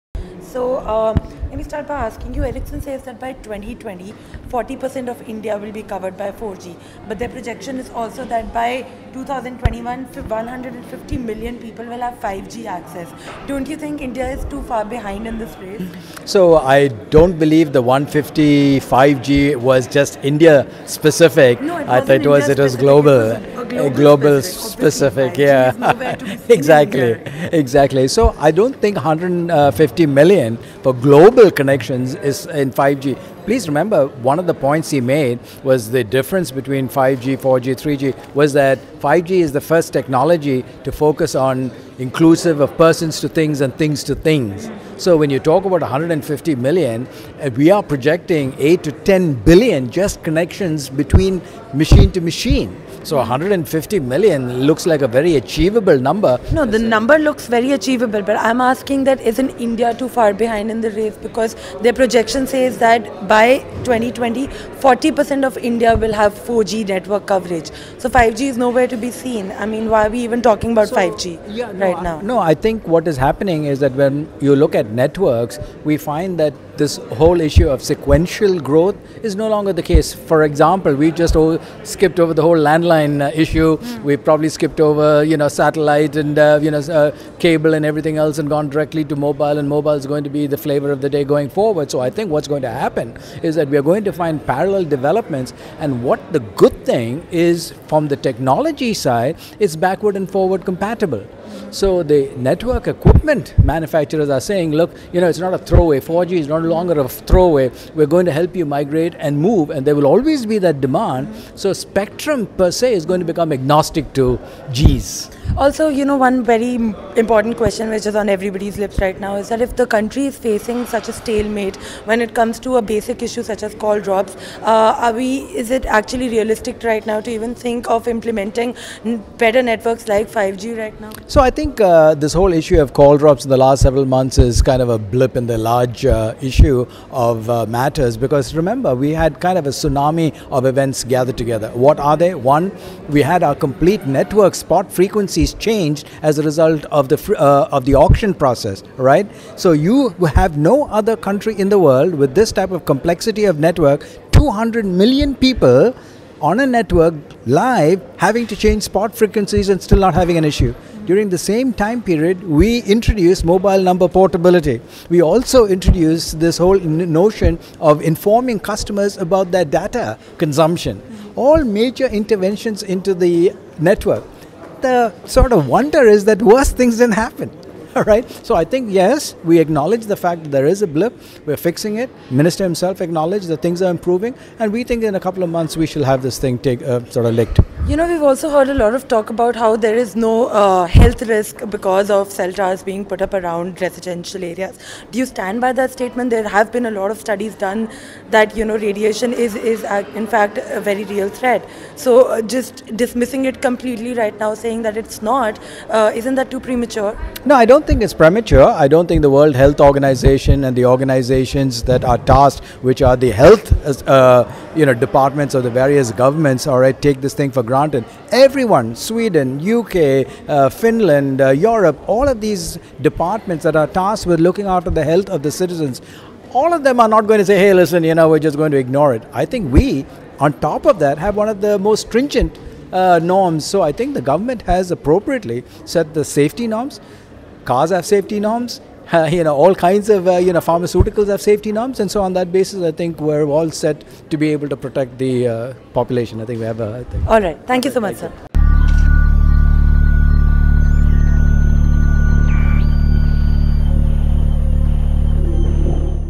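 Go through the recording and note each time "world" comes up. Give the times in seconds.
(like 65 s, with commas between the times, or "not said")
151 s, 209 s.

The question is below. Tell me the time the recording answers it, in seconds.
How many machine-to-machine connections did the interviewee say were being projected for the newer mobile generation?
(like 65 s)
48 s.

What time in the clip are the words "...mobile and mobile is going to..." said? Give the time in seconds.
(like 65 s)
89 s.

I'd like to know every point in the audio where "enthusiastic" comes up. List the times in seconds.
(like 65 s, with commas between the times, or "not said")
not said.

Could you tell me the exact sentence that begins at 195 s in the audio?
Do you stand by that statement?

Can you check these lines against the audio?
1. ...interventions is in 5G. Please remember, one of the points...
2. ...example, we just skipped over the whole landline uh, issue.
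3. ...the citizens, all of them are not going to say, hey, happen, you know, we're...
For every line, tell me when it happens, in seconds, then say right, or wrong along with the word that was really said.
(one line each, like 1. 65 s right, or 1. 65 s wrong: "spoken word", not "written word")
1. 31 s wrong: "connections", not "interventions"
2. 80 s right
3. 225 s wrong: "listen", not "happen".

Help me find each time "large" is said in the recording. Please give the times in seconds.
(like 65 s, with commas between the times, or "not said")
135 s.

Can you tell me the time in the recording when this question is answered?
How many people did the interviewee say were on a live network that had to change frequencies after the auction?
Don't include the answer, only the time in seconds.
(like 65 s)
154 s.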